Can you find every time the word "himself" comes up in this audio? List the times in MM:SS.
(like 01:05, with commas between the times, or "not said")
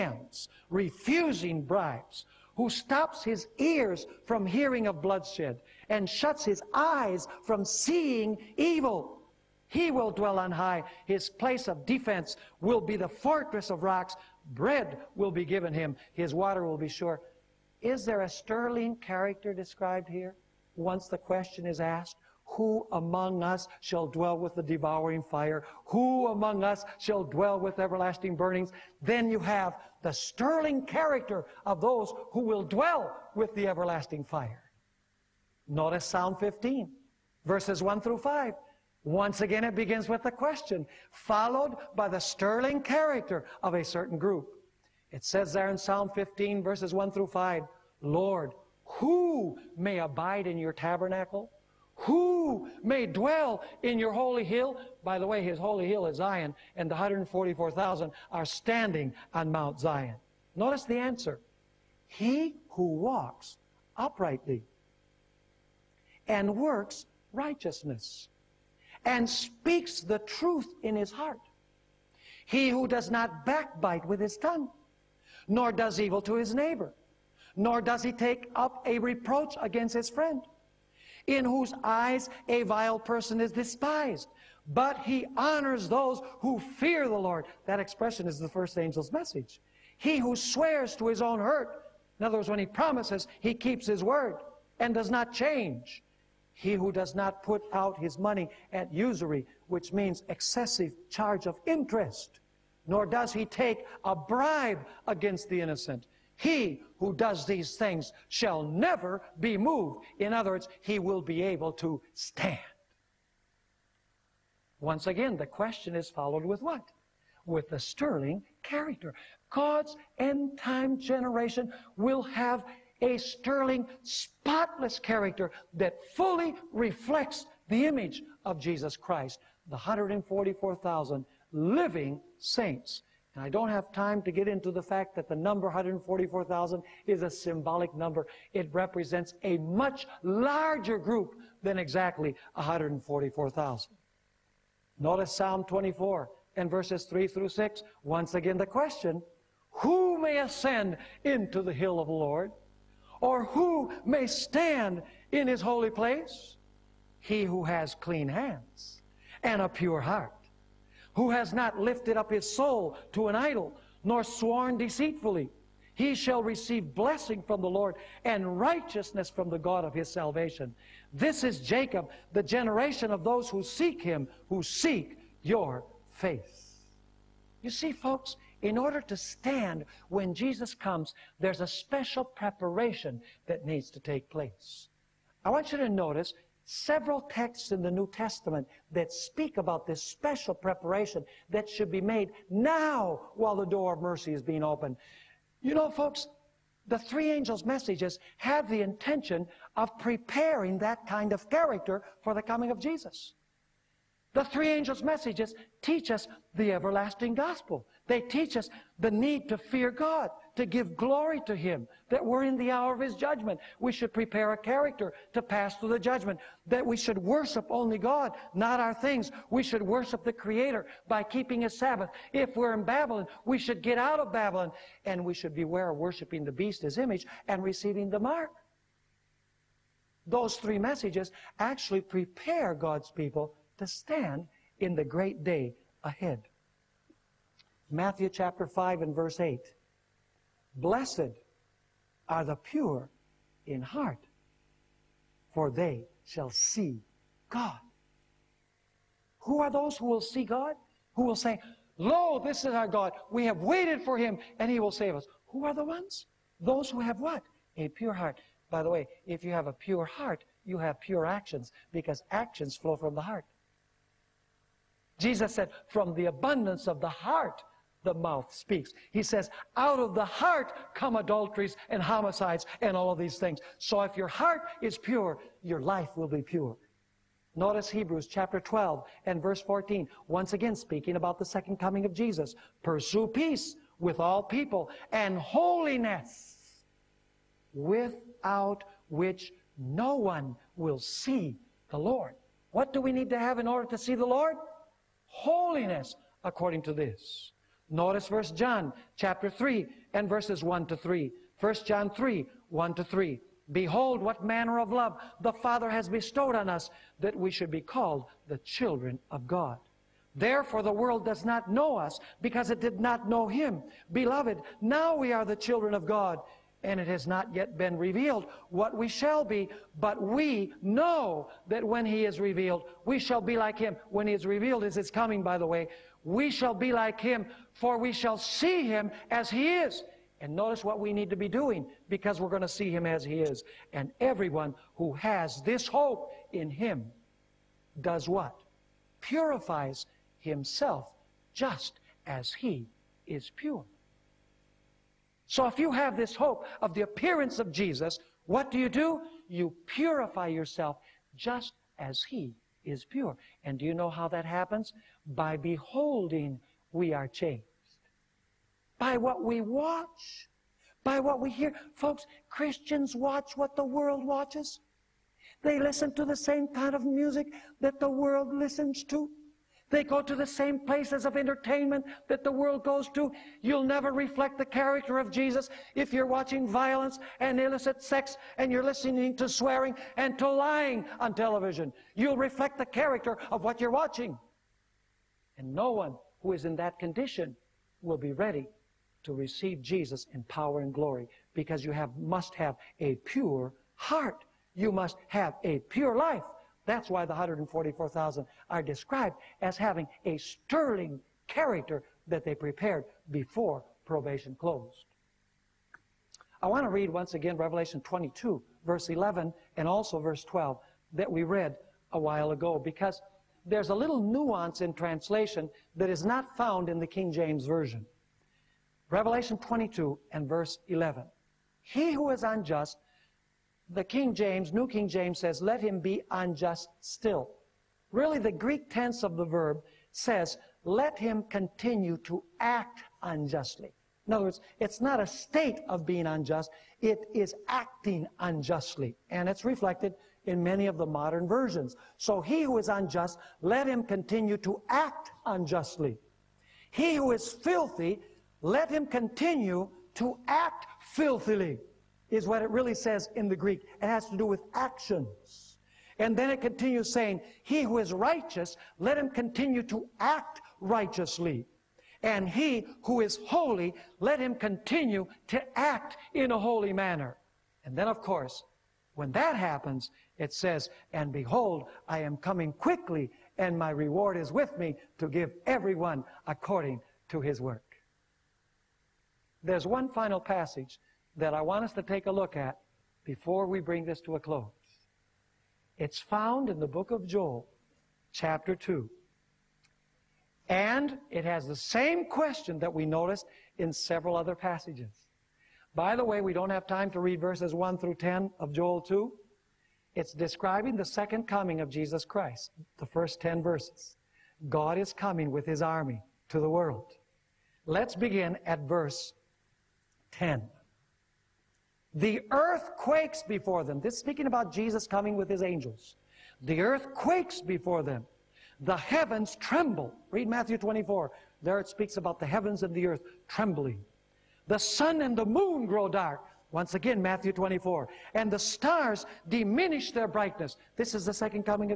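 05:40.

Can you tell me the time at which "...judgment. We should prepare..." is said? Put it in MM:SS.
03:33.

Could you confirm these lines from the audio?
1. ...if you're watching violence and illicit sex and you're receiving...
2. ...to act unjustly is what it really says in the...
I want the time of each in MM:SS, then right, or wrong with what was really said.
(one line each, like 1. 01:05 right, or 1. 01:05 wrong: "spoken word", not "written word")
1. 06:15 wrong: "listening", not "receiving"
2. 07:30 wrong: "filthily", not "unjustly".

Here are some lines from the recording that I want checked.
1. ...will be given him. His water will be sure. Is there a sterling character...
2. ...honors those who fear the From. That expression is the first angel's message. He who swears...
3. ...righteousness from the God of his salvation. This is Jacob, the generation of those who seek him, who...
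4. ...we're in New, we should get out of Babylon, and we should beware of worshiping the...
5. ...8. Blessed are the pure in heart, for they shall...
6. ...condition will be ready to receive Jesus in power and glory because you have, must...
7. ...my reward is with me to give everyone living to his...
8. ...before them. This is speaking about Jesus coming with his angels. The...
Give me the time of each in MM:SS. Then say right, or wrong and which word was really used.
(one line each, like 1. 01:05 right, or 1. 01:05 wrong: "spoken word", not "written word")
1. 00:15 right
2. 01:25 wrong: "Lord", not "From"
3. 02:48 right
4. 03:42 wrong: "Babylon", not "New"
5. 03:59 right
6. 06:26 right
7. 07:53 wrong: "according", not "living"
8. 08:33 right.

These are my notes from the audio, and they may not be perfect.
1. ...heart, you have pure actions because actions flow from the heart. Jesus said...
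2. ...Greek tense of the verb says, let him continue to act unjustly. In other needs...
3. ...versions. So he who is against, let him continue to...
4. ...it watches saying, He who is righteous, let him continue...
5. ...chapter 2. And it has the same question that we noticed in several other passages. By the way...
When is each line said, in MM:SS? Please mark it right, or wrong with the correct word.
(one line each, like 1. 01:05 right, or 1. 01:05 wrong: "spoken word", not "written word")
1. 04:20 right
2. 07:08 wrong: "words", not "needs"
3. 07:21 wrong: "unjust", not "against"
4. 07:36 wrong: "continues", not "watches"
5. 08:08 right.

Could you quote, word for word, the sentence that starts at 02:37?
He who has clean hands and a pure heart who has not lifted up his soul to an idol, nor sworn deceitfully.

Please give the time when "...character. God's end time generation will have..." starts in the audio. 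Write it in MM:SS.
01:58.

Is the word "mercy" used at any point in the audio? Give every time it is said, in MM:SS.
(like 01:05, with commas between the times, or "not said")
03:14.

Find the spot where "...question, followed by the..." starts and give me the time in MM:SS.
00:40.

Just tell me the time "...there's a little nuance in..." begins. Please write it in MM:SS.
06:53.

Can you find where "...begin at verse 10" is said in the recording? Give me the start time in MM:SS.
08:28.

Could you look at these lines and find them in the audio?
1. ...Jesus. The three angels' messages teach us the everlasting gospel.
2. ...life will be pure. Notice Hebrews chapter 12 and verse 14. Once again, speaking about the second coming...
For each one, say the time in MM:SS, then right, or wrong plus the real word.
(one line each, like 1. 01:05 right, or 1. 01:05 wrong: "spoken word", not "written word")
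1. 03:22 right
2. 04:35 right.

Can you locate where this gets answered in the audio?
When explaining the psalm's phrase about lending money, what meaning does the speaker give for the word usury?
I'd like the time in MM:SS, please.
01:40.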